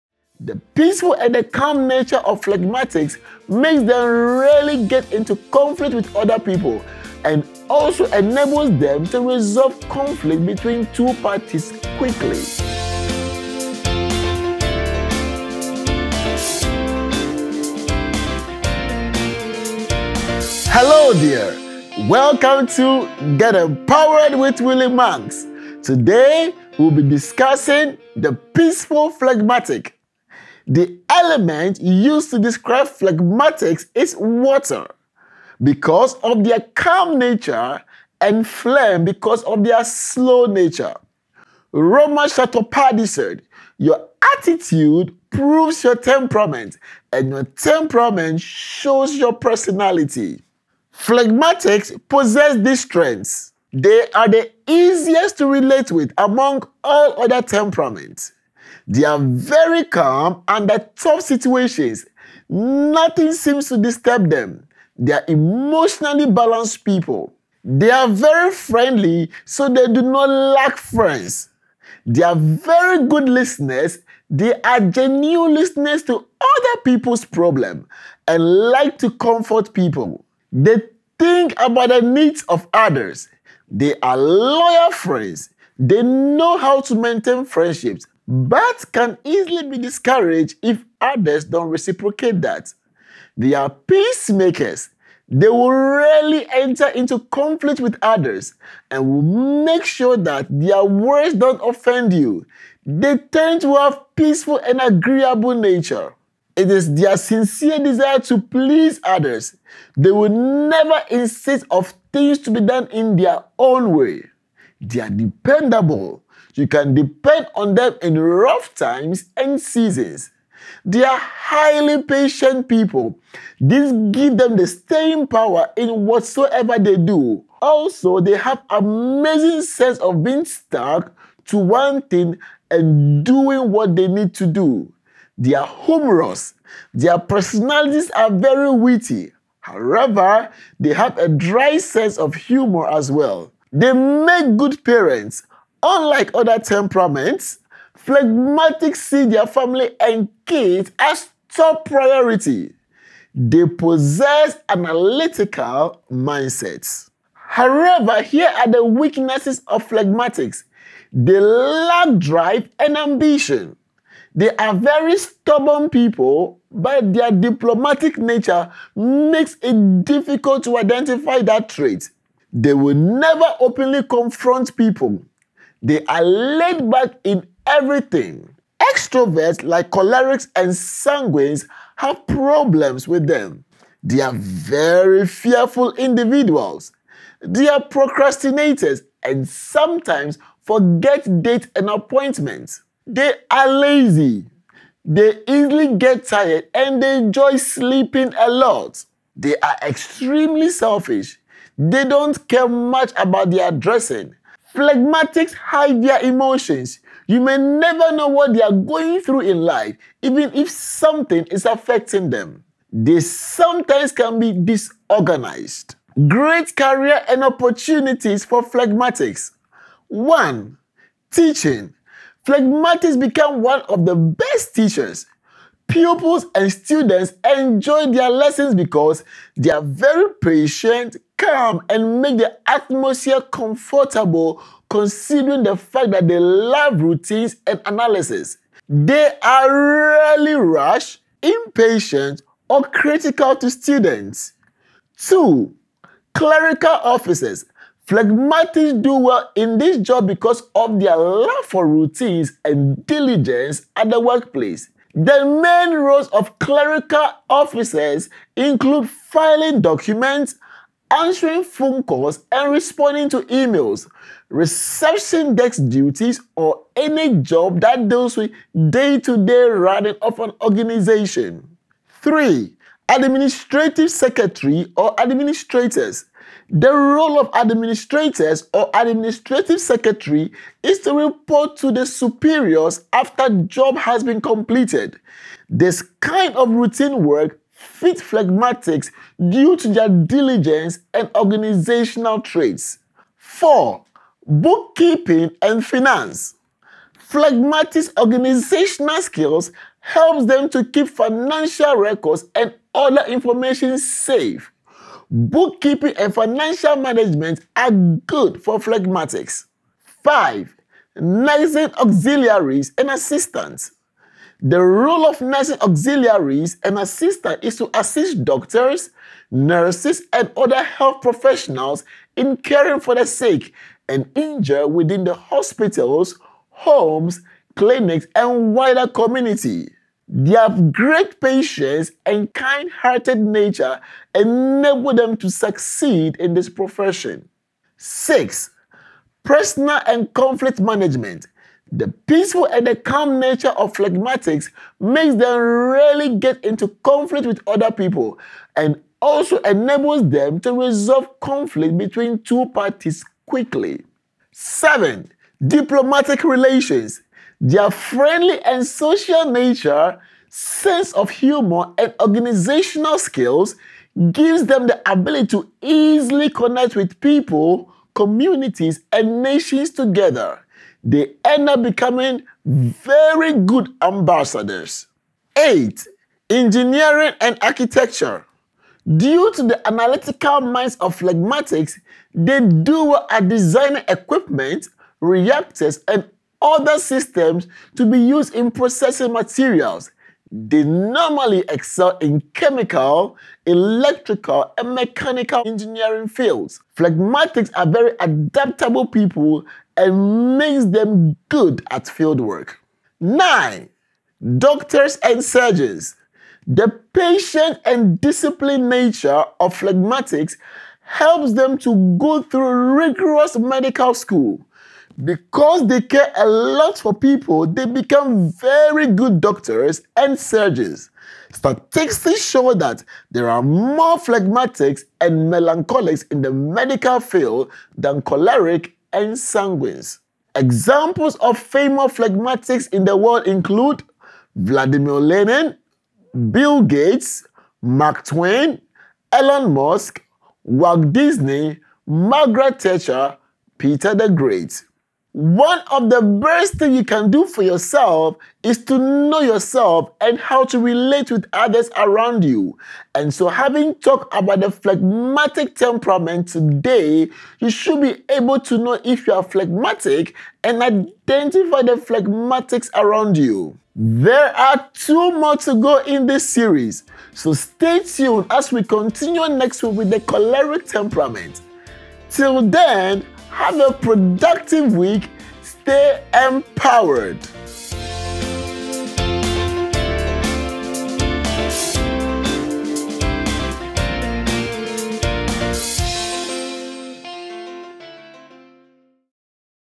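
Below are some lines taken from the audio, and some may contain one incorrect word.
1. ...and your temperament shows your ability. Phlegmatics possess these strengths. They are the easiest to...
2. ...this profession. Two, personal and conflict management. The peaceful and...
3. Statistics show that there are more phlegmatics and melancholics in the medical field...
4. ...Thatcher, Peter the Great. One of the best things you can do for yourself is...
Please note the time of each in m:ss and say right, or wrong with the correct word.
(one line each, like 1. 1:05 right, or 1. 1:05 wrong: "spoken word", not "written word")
1. 0:47 wrong: "personality", not "ability"
2. 5:36 wrong: "Six", not "Two"
3. 7:01 right
4. 7:22 right.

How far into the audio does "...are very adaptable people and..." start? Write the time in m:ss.
6:37.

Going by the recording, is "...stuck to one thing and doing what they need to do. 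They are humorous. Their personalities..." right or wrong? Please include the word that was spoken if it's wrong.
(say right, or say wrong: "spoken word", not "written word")
right.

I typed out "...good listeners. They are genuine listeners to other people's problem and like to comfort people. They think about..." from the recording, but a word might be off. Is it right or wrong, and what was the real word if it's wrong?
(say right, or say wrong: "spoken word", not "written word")
right.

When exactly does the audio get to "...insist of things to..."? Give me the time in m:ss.
1:51.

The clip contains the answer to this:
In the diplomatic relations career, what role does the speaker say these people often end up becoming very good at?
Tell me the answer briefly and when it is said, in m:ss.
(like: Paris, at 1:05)
ambassadors, at 6:14.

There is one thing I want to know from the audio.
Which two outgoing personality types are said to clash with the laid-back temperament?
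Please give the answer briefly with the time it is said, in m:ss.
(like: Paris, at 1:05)
cholerics and sanguines, at 2:59.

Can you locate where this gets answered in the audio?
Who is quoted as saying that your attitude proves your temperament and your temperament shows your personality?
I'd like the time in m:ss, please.
0:41.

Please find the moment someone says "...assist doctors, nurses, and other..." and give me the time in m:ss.
5:17.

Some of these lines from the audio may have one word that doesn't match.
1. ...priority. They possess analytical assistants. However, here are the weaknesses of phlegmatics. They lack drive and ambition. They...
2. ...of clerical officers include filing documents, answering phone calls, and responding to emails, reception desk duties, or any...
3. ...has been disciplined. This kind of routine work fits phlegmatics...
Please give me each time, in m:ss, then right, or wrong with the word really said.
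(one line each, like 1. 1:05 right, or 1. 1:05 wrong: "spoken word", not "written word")
1. 2:31 wrong: "mindsets", not "assistants"
2. 4:16 right
3. 4:43 wrong: "completed", not "disciplined".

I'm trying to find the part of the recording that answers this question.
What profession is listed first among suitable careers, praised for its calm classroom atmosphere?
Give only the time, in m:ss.
3:41.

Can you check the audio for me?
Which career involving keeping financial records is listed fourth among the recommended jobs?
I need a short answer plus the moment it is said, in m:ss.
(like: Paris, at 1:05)
Bookkeeping and finance, at 4:54.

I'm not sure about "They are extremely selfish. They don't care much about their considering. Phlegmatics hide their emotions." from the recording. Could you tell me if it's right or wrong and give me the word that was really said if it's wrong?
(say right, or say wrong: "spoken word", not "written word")
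wrong: "dressing", not "considering".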